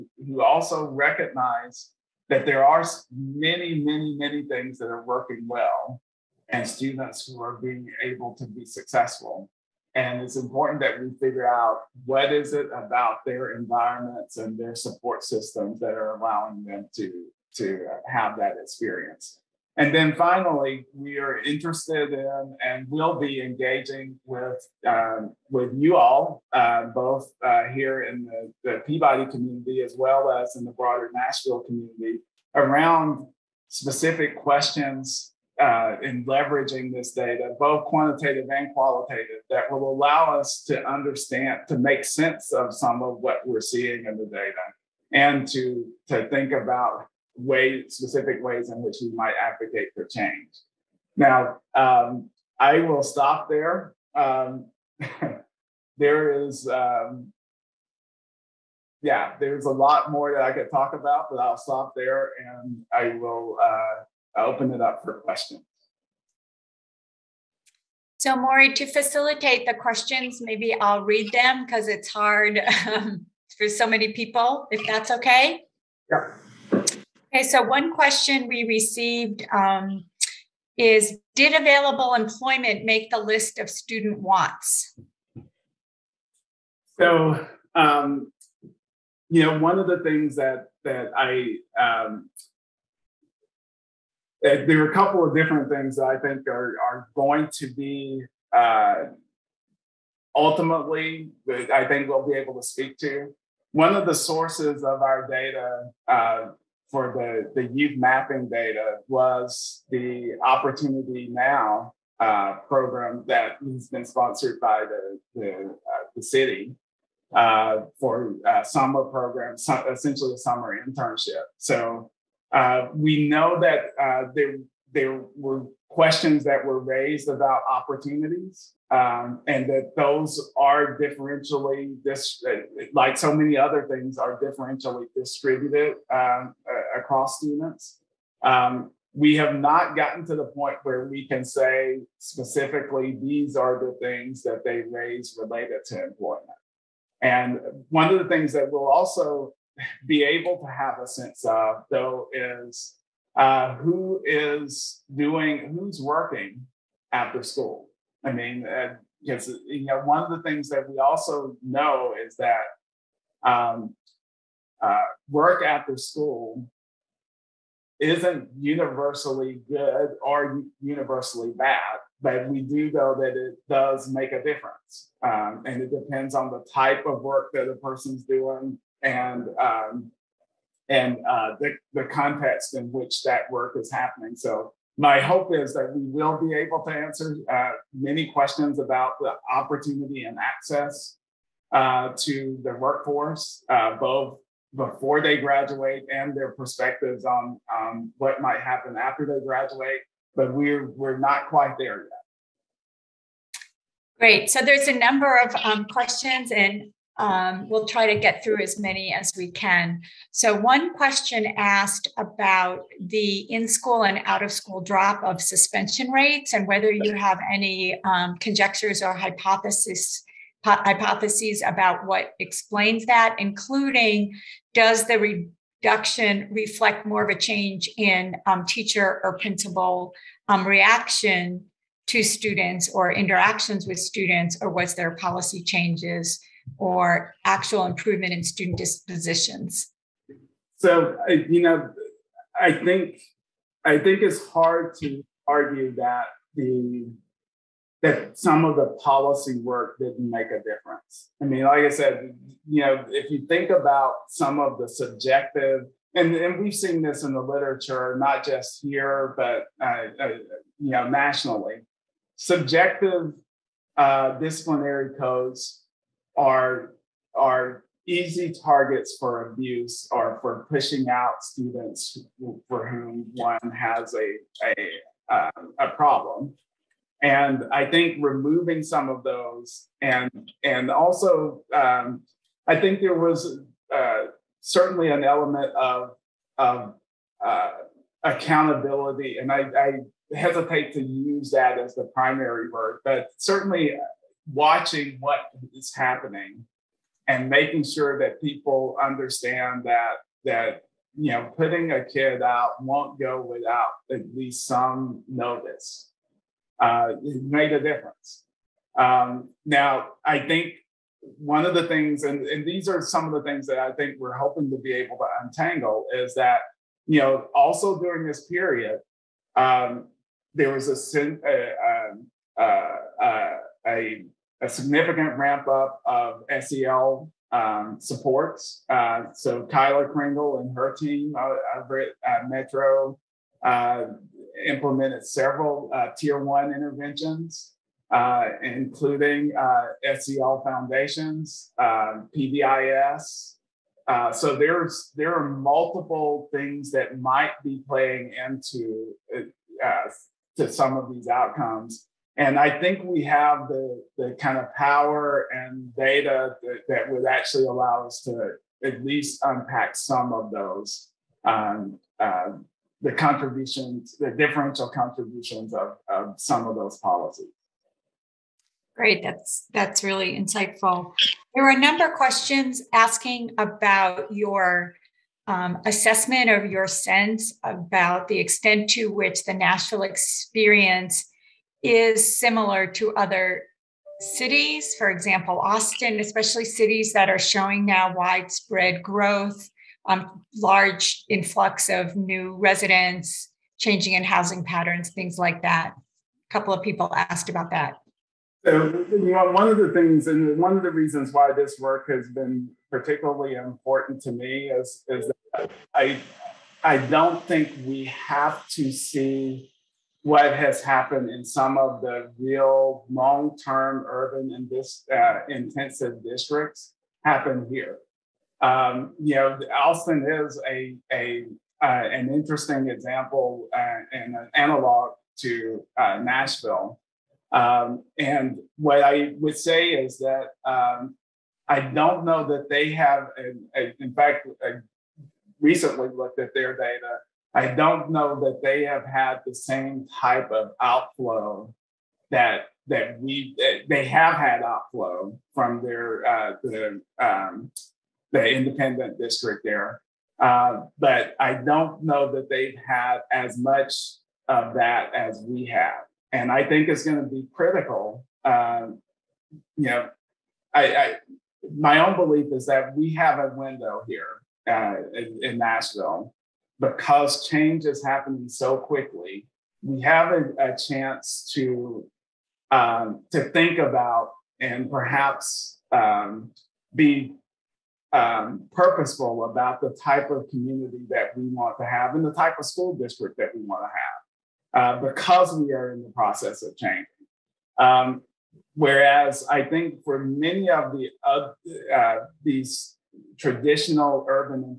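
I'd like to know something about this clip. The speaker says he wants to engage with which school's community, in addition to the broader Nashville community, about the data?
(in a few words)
Peabody.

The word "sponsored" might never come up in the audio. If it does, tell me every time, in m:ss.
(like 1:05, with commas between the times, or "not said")
1:54.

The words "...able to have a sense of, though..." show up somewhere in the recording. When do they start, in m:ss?
2:30.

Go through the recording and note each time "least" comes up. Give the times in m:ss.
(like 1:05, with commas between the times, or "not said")
5:04, 5:59.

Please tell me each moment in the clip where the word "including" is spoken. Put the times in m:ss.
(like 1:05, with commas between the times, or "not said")
3:43, 5:38.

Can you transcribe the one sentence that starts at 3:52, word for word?
To students or interactions with students, or was there policy changes or actual improvement in student dispositions?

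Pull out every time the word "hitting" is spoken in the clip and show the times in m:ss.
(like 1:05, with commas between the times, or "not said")
not said.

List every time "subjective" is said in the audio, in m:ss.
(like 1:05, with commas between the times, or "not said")
4:14, 4:22.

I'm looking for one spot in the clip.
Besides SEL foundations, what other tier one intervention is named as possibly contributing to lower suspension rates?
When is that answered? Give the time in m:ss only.
5:42.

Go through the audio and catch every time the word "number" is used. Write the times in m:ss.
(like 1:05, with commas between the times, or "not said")
3:24, 6:11.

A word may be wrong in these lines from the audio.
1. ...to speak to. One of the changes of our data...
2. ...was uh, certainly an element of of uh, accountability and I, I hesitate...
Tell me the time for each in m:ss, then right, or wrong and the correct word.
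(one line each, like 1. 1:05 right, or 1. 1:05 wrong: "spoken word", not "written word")
1. 1:42 wrong: "sources", not "changes"
2. 4:43 right.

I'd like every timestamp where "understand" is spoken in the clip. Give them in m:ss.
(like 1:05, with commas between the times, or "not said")
0:40, 4:59.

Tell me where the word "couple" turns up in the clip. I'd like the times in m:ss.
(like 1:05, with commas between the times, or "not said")
1:34, 6:36.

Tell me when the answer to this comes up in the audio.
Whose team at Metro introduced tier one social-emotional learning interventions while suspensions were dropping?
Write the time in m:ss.
5:29.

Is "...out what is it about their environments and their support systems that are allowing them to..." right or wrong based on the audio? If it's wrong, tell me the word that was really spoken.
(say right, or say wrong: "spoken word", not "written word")
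right.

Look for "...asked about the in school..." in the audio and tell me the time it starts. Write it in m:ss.
3:31.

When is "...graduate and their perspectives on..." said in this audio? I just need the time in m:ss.
3:15.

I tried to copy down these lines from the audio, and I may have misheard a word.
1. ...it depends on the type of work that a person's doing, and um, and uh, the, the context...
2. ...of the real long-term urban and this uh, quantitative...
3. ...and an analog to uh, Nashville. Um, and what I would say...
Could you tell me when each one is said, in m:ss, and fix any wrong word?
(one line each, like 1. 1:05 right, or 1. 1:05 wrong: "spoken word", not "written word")
1. 2:55 right
2. 6:51 wrong: "intensive", not "quantitative"
3. 7:04 right.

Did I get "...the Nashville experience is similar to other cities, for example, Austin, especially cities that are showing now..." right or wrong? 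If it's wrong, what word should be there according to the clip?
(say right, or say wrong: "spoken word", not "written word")
right.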